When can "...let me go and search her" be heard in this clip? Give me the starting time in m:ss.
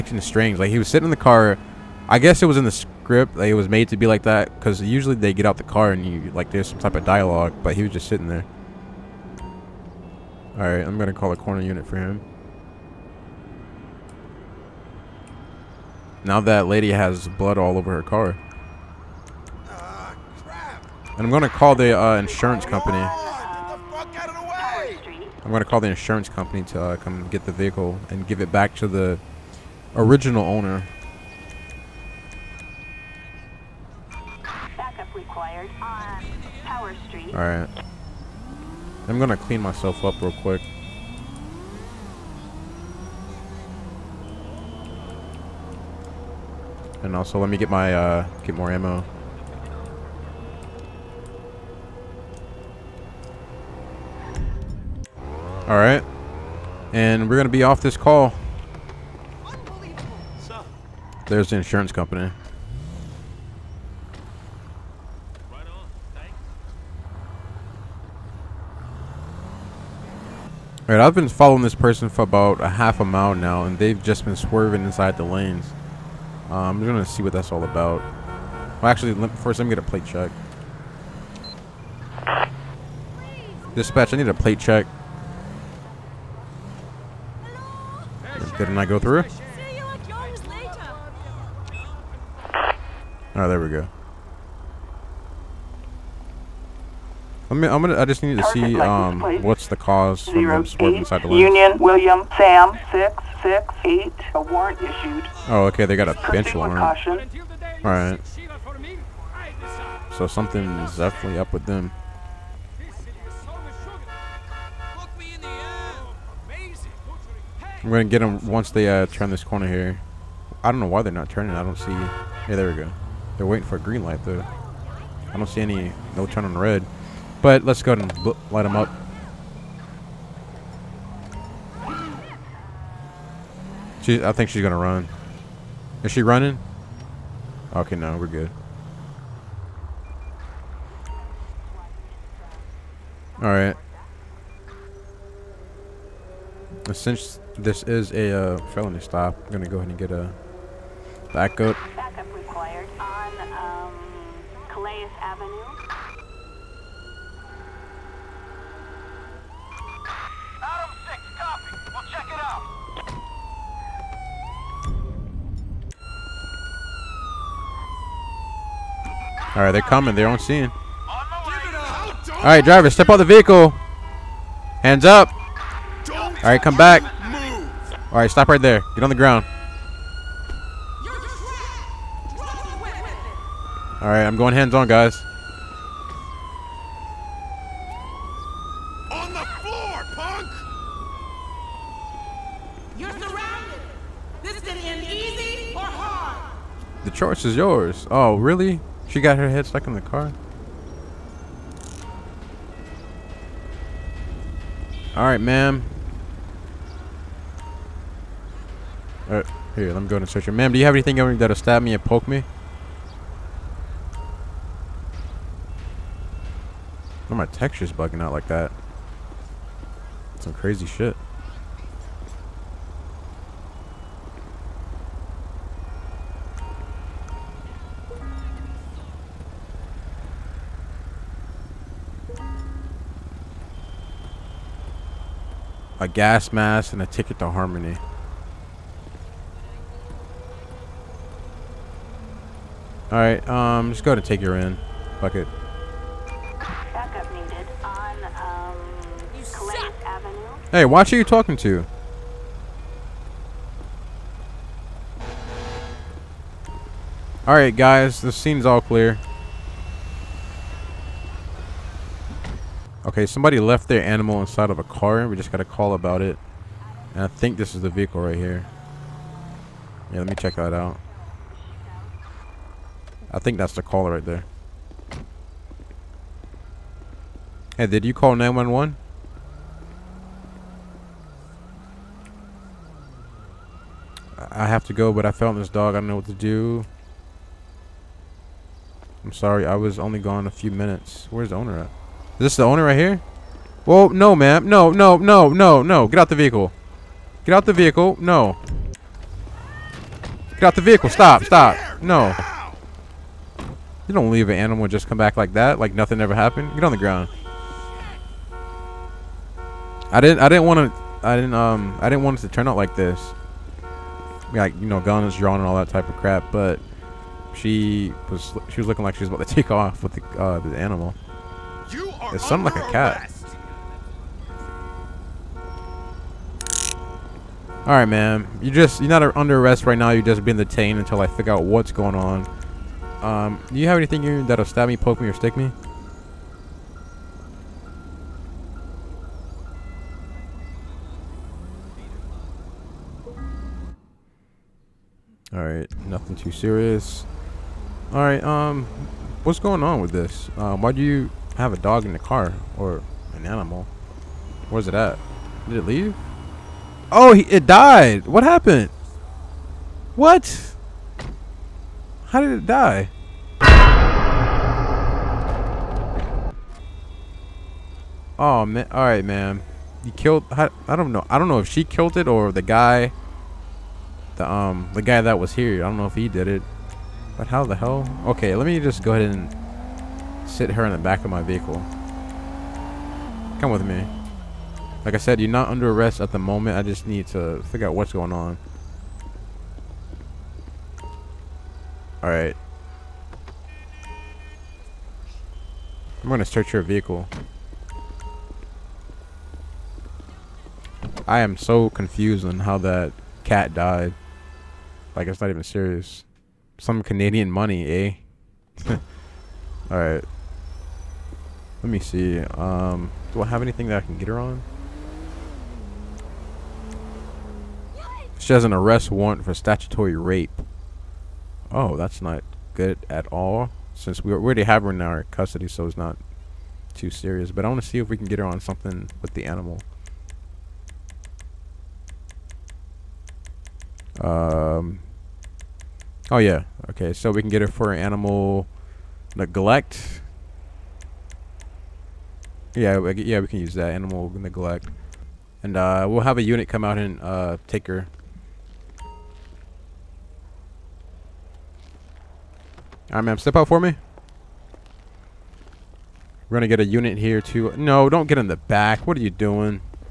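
3:29.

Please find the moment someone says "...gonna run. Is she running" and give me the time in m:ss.
2:14.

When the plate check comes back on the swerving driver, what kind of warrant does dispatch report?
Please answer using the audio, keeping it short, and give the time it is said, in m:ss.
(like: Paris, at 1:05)
Bench warrant, at 1:46.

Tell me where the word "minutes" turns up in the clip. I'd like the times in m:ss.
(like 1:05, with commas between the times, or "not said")
4:50.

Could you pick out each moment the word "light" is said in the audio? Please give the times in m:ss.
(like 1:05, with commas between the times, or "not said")
2:04, 2:08.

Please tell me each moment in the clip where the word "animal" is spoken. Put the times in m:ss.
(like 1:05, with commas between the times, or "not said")
4:24, 5:04, 5:20, 5:53, 7:09, 7:17, 7:23.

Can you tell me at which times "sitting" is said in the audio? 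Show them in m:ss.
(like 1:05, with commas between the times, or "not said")
0:00, 0:08.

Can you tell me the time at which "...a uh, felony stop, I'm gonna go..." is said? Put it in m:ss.
2:28.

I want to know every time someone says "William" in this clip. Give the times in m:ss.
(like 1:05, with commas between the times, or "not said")
1:41.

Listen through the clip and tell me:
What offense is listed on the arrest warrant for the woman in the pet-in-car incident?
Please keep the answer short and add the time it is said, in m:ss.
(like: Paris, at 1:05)
Statutory rape, at 6:59.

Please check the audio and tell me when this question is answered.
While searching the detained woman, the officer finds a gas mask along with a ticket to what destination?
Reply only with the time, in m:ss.
3:57.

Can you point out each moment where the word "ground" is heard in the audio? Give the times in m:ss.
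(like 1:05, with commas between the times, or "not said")
2:59, 5:06.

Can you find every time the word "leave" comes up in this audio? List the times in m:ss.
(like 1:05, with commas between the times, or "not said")
5:04, 5:55.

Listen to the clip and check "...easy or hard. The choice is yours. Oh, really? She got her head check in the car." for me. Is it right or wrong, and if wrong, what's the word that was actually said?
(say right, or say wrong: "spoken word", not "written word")
wrong: "stuck", not "check".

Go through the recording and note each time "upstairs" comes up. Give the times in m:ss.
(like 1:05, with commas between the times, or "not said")
not said.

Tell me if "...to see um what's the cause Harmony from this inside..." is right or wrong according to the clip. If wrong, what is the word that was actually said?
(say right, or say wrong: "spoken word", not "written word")
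wrong: "Zero", not "Harmony".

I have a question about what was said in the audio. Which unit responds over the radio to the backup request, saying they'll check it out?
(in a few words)
Adam 6.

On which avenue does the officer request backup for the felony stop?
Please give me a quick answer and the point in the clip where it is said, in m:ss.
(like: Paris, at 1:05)
Calais Avenue, at 2:34.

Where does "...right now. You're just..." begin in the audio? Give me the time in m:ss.
5:29.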